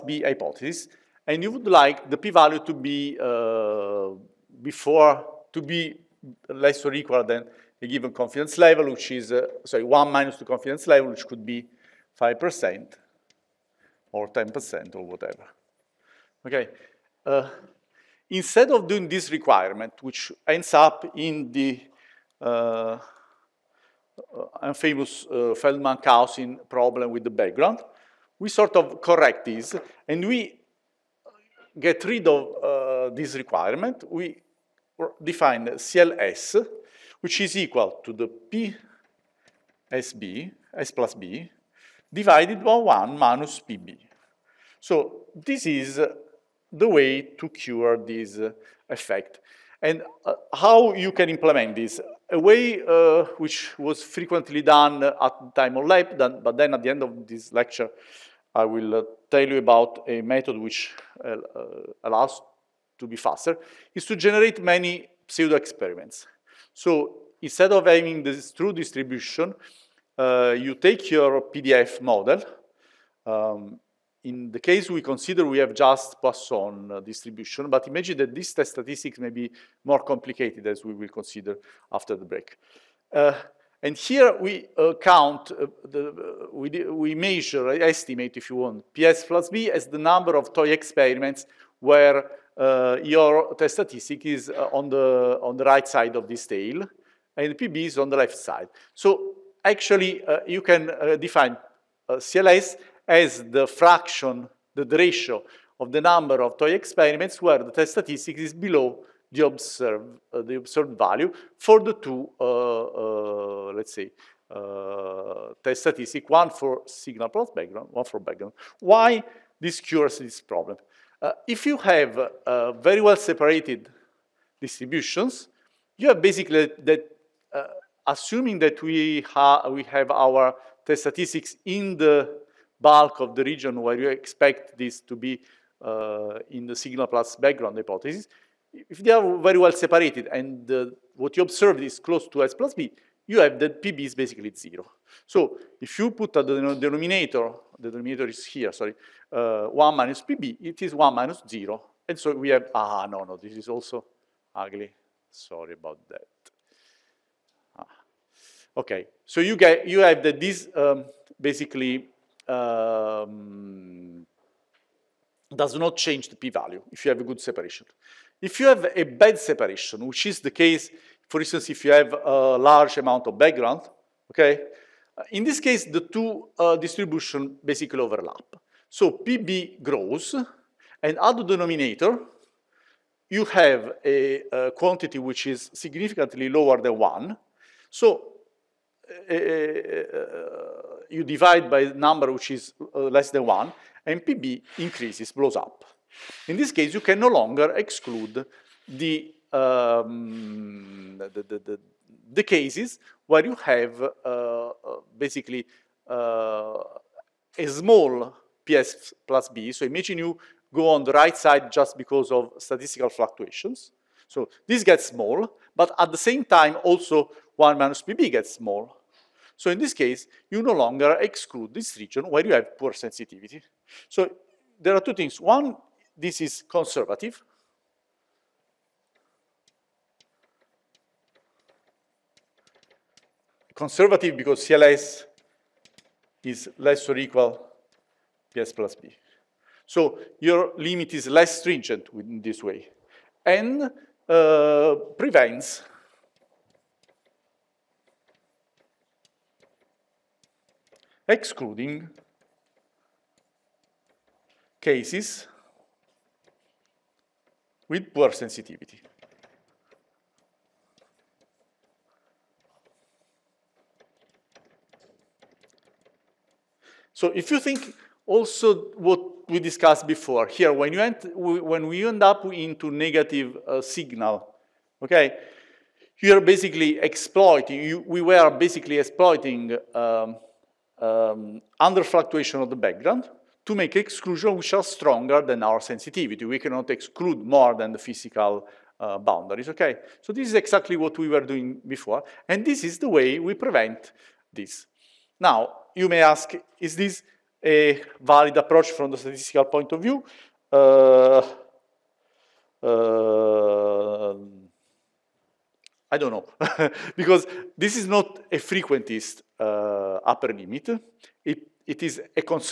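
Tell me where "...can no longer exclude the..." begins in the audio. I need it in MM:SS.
03:16.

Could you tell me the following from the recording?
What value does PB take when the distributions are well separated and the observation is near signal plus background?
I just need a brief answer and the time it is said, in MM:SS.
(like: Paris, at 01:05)
0, at 02:24.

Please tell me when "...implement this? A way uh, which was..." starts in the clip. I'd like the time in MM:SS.
00:51.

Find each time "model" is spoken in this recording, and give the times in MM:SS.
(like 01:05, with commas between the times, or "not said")
01:12.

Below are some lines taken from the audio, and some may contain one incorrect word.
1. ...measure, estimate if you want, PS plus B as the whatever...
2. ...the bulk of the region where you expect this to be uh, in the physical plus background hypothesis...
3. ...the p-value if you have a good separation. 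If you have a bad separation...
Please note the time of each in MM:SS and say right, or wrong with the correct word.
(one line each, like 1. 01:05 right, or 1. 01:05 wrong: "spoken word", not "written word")
1. 01:27 wrong: "number", not "whatever"
2. 02:11 wrong: "signal", not "physical"
3. 02:46 right.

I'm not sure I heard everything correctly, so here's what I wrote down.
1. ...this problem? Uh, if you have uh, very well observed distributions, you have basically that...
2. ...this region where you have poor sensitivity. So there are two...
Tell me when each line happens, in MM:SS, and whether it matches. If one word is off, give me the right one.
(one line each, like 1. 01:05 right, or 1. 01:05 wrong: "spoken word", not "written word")
1. 02:00 wrong: "separated", not "observed"
2. 03:41 right.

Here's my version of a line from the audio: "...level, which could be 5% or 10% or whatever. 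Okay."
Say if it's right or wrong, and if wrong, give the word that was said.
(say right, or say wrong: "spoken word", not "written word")
right.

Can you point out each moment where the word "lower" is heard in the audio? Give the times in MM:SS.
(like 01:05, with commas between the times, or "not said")
03:06.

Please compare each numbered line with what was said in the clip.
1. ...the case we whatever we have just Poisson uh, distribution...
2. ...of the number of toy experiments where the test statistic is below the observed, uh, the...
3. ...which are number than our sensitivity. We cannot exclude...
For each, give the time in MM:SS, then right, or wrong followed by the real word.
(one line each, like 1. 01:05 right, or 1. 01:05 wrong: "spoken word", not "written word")
1. 01:14 wrong: "consider", not "whatever"
2. 01:45 right
3. 04:44 wrong: "stronger", not "number".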